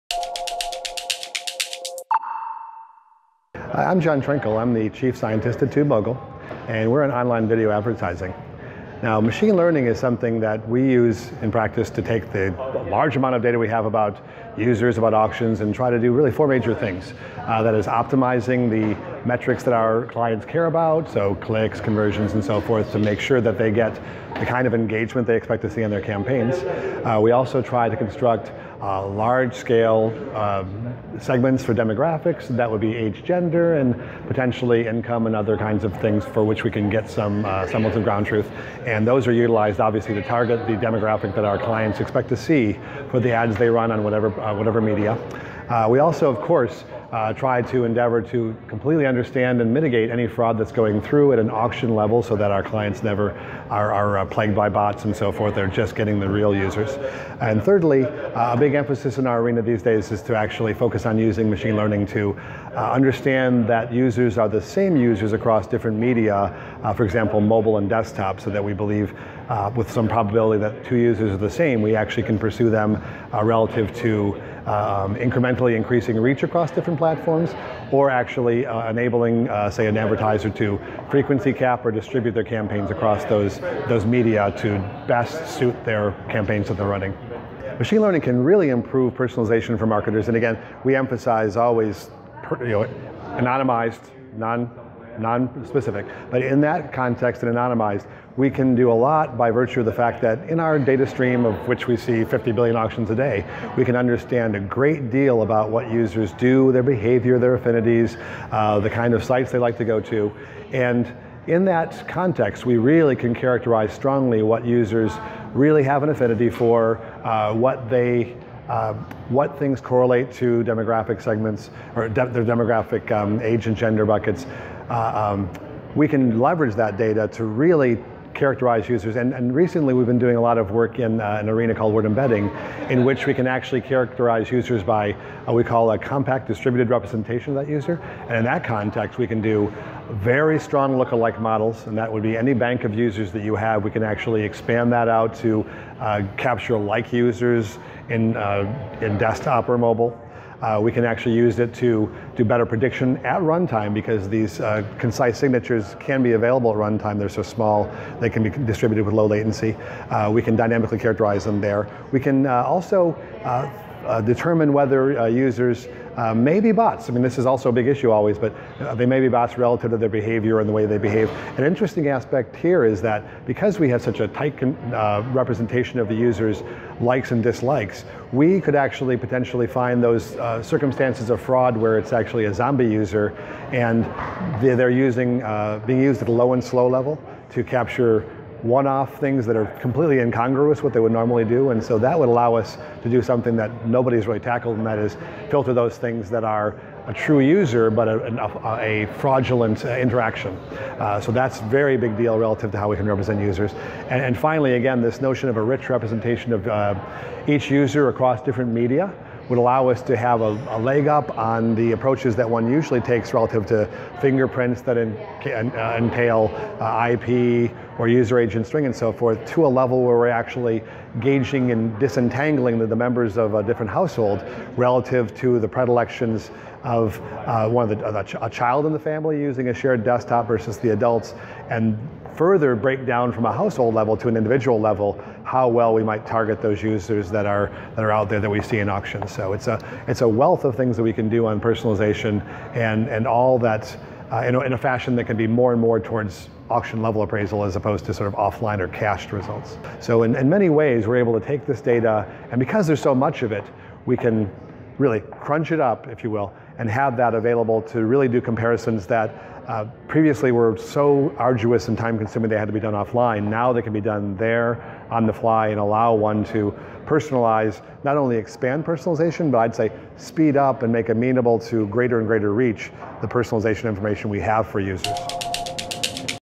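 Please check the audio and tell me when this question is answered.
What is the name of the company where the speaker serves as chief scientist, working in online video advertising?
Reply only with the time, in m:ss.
0:05.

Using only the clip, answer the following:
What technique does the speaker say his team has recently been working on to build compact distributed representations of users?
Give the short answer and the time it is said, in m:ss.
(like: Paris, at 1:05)
word embedding, at 2:11.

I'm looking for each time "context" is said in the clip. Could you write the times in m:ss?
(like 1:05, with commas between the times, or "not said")
1:36, 1:52, 2:18.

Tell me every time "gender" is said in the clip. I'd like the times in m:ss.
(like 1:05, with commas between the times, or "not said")
0:33, 2:03.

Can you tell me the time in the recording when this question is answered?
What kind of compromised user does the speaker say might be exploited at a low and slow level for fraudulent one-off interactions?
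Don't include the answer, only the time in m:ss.
3:02.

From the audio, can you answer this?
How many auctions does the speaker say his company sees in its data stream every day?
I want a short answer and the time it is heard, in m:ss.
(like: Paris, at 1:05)
50 billion, at 1:42.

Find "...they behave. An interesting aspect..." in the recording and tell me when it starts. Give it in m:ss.
2:50.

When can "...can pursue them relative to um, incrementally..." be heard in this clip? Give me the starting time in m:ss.
1:12.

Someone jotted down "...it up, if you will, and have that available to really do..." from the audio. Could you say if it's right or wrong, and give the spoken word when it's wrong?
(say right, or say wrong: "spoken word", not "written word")
right.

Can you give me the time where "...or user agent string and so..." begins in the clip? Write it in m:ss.
3:37.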